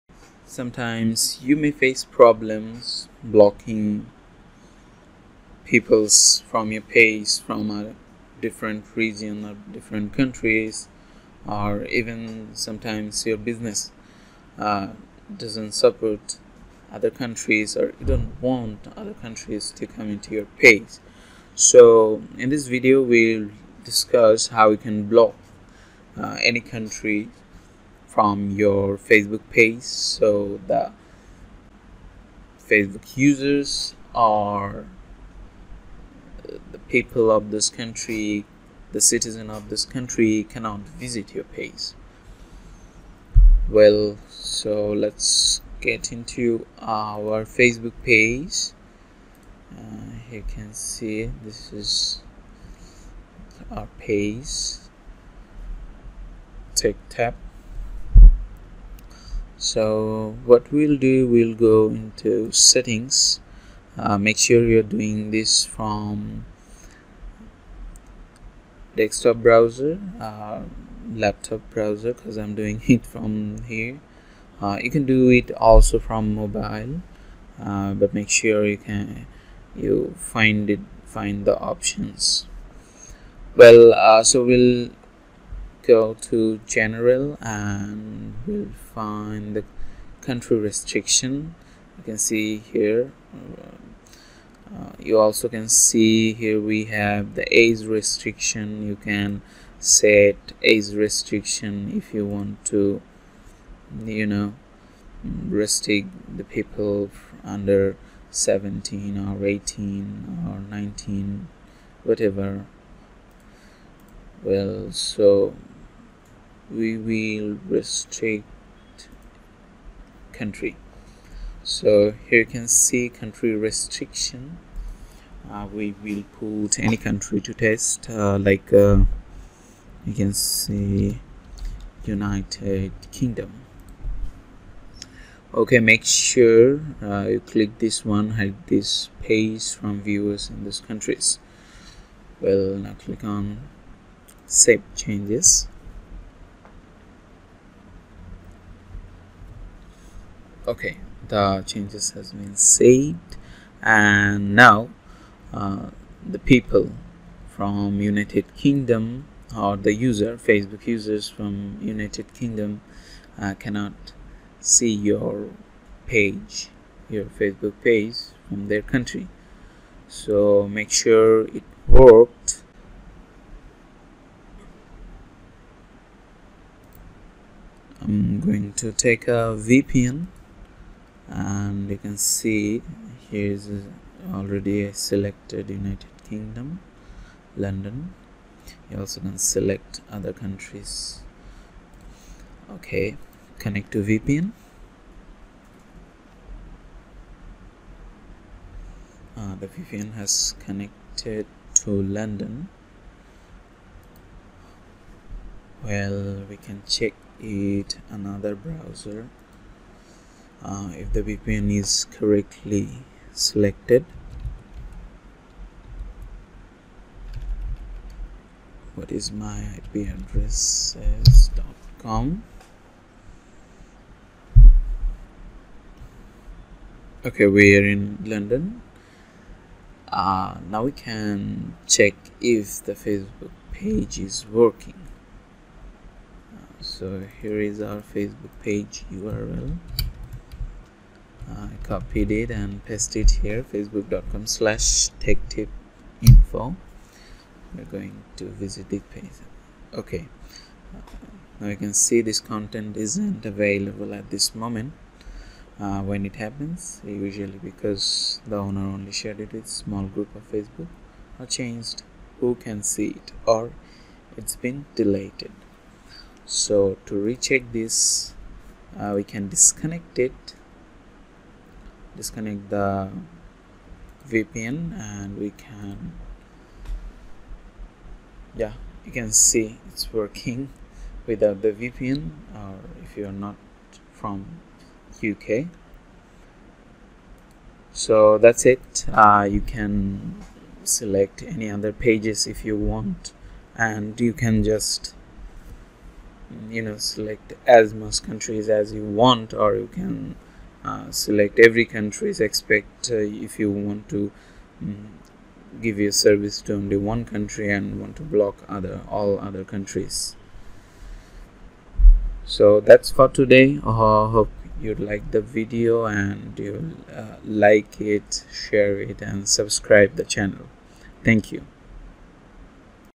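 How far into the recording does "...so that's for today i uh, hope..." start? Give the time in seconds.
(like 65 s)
312 s.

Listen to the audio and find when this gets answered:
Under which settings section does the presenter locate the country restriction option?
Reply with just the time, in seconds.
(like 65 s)
86 s.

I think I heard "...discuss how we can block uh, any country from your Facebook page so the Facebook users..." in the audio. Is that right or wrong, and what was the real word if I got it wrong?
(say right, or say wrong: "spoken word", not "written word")
right.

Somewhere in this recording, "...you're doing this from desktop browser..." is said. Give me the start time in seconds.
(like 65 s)
64 s.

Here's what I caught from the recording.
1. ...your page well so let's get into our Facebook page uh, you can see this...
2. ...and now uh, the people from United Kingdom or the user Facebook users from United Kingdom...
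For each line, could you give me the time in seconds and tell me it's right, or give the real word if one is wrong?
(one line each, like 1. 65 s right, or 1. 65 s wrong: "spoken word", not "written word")
1. 41 s right
2. 153 s right.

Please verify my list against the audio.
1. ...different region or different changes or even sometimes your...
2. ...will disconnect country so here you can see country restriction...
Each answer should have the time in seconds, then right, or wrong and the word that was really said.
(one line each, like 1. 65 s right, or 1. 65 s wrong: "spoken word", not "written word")
1. 8 s wrong: "countries", not "changes"
2. 116 s wrong: "restrict", not "disconnect".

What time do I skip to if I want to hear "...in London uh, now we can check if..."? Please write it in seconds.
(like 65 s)
227 s.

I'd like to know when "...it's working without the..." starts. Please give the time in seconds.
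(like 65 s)
279 s.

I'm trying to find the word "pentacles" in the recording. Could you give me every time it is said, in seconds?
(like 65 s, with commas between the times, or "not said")
not said.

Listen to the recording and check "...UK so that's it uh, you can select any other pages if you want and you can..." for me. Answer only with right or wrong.
right.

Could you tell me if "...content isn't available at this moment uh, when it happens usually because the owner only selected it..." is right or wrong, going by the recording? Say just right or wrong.
wrong.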